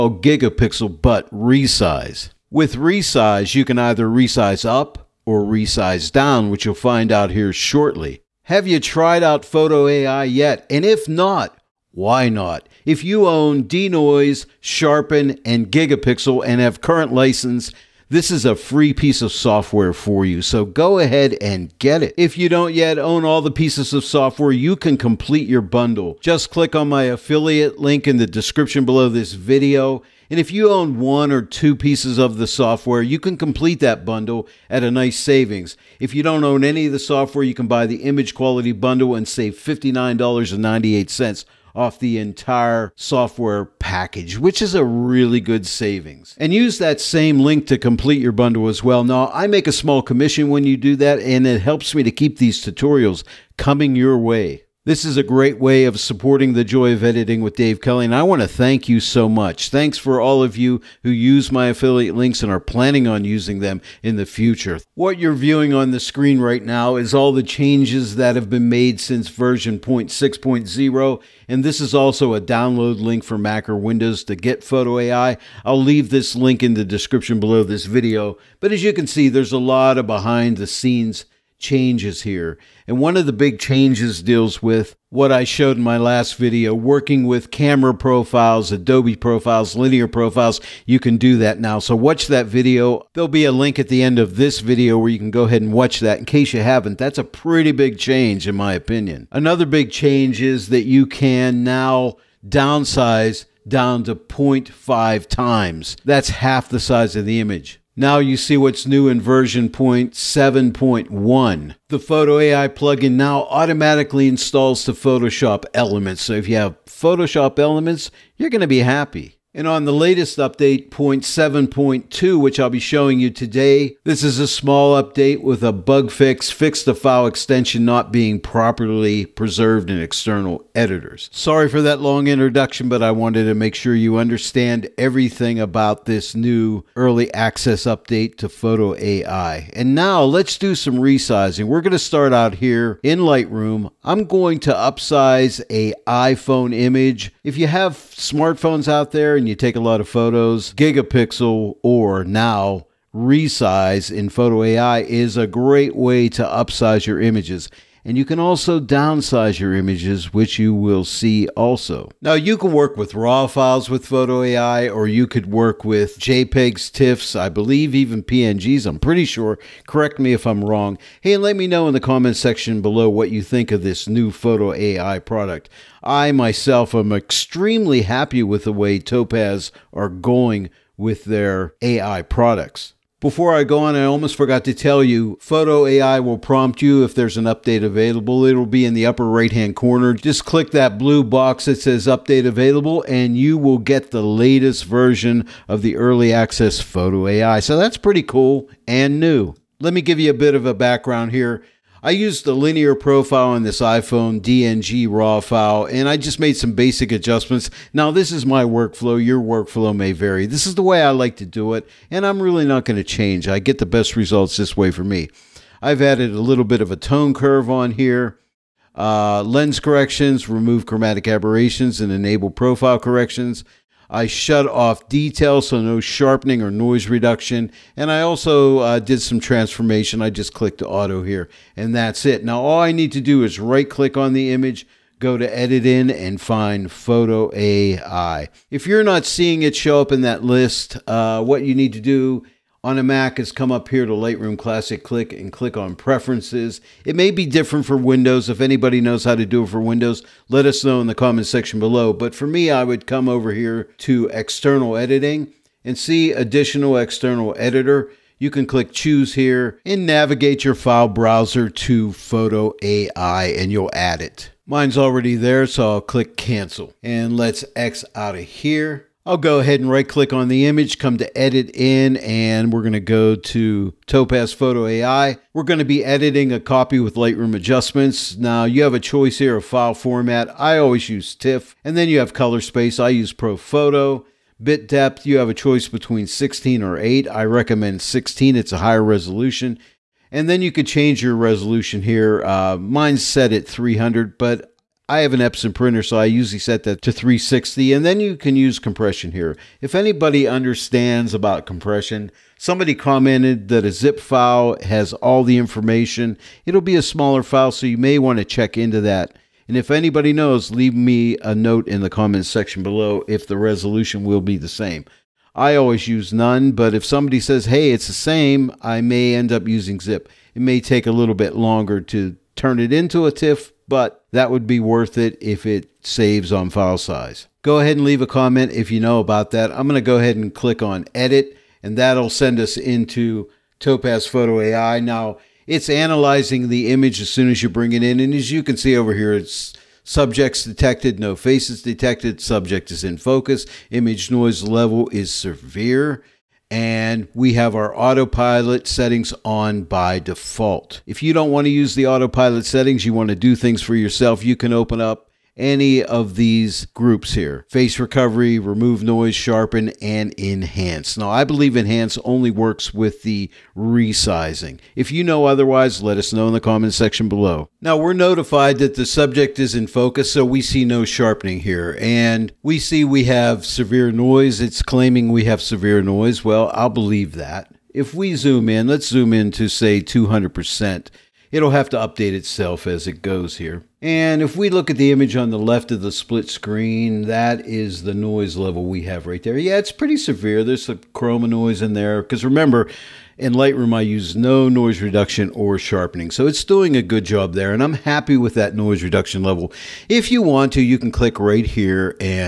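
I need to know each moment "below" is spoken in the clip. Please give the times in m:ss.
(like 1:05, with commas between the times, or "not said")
0:28, 1:17, 2:52, 4:11, 5:12, 6:07.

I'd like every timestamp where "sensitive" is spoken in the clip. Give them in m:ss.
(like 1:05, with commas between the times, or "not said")
not said.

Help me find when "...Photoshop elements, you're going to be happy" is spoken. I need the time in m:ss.
1:56.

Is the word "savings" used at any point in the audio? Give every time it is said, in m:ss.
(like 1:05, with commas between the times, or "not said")
0:35, 0:45.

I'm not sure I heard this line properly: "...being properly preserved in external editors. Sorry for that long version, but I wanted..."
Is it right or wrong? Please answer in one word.
wrong.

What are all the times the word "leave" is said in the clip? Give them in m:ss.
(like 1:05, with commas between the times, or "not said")
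1:15, 5:10, 5:28.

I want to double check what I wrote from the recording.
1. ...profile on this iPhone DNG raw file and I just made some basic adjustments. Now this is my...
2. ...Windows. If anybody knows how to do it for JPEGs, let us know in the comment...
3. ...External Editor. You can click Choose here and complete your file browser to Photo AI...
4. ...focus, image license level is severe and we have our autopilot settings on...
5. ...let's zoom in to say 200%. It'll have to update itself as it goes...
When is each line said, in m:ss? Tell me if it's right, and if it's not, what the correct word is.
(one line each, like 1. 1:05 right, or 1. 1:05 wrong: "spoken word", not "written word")
1. 3:22 right
2. 4:07 wrong: "Windows", not "JPEGs"
3. 4:16 wrong: "navigate", not "complete"
4. 5:43 wrong: "noise", not "license"
5. 6:18 right.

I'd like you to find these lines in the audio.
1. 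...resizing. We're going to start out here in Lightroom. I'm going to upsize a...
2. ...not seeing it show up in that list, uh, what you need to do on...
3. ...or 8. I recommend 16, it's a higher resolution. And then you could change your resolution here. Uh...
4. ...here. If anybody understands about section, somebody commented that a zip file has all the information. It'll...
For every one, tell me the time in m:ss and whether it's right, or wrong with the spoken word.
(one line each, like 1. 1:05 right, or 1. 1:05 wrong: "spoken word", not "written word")
1. 2:20 right
2. 3:59 right
3. 4:46 right
4. 4:59 wrong: "compression", not "section".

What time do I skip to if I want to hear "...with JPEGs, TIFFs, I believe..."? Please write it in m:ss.
2:45.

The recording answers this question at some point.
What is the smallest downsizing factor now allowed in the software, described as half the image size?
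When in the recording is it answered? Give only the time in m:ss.
1:44.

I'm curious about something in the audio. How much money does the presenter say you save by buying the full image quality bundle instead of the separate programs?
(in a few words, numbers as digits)
$59.98.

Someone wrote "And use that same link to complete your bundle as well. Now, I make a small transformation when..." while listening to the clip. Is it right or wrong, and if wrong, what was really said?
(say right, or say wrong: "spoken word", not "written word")
wrong: "commission", not "transformation".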